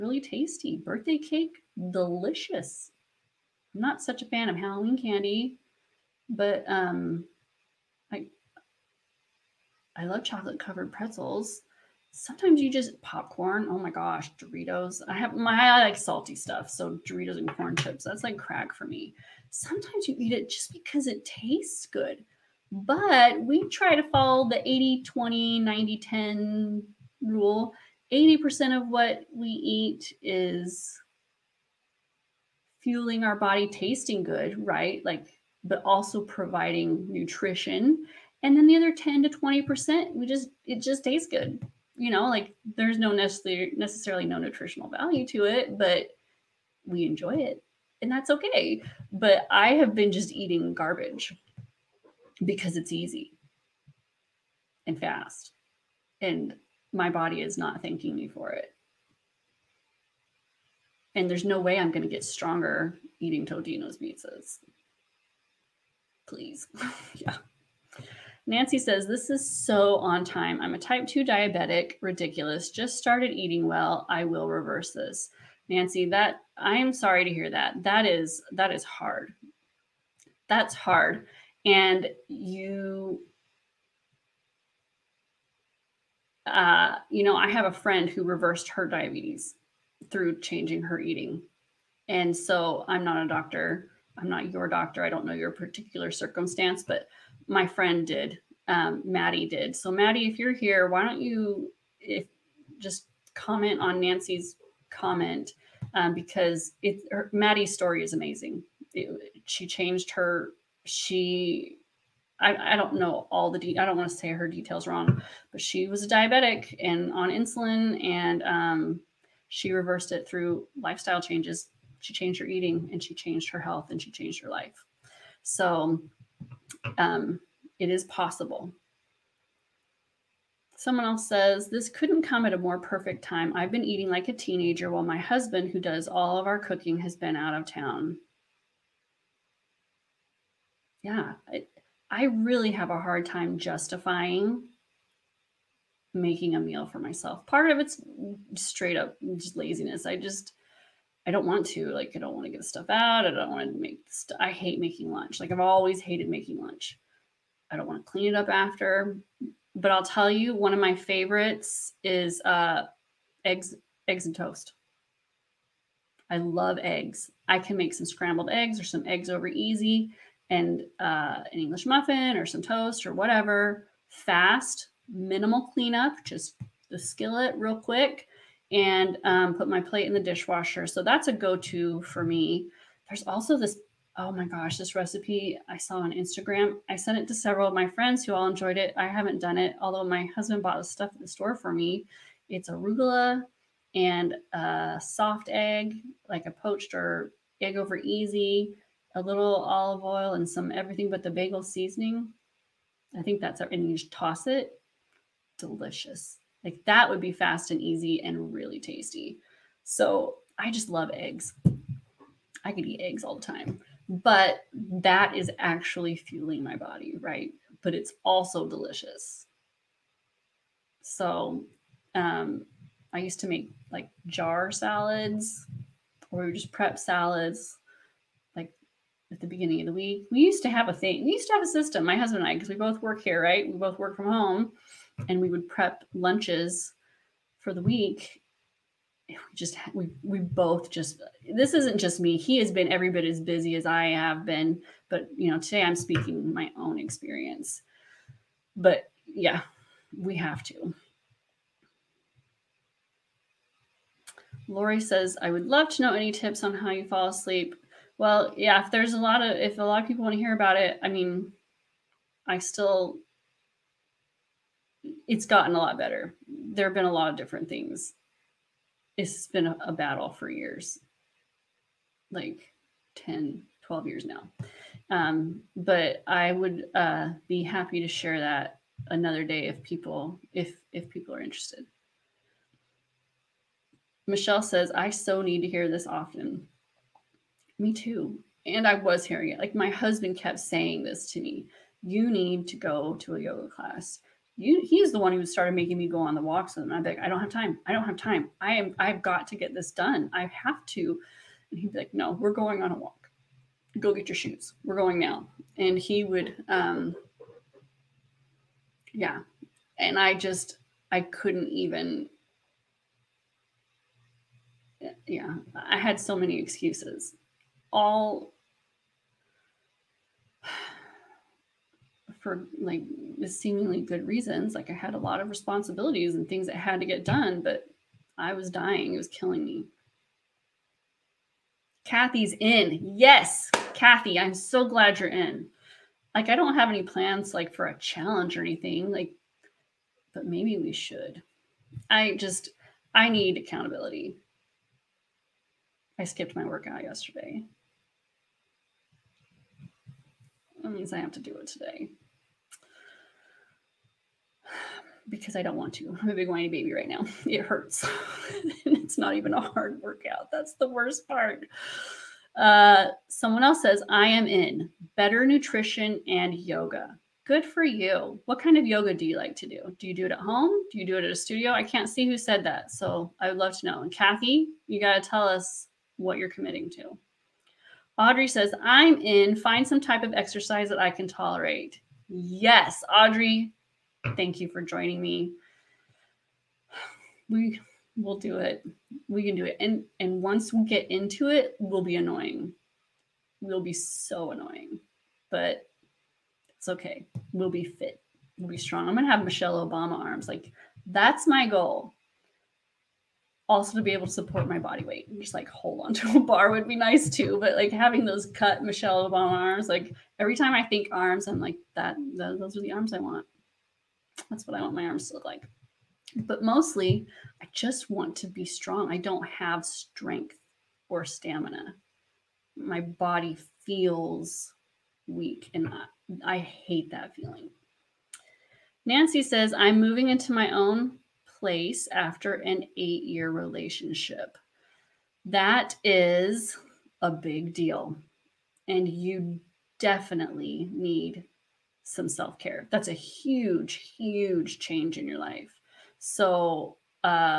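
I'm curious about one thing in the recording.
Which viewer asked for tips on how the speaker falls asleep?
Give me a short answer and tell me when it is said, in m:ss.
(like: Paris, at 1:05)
Lori, at 4:14.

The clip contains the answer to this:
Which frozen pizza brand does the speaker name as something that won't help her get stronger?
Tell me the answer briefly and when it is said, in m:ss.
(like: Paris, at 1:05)
Totino's, at 1:03.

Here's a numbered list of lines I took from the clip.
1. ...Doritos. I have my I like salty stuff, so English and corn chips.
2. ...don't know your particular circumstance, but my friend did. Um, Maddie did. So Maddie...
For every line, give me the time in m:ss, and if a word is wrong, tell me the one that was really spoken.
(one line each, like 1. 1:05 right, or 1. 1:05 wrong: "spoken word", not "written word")
1. 0:14 wrong: "Doritos", not "English"
2. 1:35 right.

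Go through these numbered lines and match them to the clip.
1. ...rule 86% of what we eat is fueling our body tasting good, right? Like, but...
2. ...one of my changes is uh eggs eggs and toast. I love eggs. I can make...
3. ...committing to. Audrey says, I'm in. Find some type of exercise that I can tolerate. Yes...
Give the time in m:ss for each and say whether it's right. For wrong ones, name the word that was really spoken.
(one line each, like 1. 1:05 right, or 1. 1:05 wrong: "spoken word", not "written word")
1. 0:27 wrong: "80", not "86"
2. 2:40 wrong: "favorites", not "changes"
3. 6:16 right.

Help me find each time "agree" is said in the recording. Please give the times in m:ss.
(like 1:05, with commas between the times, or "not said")
not said.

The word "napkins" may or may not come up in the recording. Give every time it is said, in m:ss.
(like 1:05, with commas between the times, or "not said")
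not said.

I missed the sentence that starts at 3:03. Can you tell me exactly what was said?
There's also this oh my gosh, this recipe I saw on Instagram.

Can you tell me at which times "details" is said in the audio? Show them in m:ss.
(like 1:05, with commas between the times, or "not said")
1:54.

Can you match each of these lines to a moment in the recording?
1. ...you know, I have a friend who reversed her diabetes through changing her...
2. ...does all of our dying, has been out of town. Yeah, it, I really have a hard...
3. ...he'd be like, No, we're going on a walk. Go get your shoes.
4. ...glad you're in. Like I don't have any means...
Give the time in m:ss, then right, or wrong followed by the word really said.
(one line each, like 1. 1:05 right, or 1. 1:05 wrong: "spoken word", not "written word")
1. 1:27 right
2. 2:15 wrong: "cooking", not "dying"
3. 5:01 right
4. 5:34 wrong: "plans", not "means".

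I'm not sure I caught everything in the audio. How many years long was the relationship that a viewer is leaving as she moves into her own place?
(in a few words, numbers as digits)
8.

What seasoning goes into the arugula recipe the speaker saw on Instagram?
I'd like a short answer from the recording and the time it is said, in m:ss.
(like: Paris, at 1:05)
everything but the bagel, at 3:20.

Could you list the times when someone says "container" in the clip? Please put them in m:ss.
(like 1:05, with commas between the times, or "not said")
not said.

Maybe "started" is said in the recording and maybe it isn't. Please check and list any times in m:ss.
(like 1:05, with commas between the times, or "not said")
1:12, 4:55.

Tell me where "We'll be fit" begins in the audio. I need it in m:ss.
6:37.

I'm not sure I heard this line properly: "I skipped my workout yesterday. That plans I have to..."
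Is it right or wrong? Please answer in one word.
wrong.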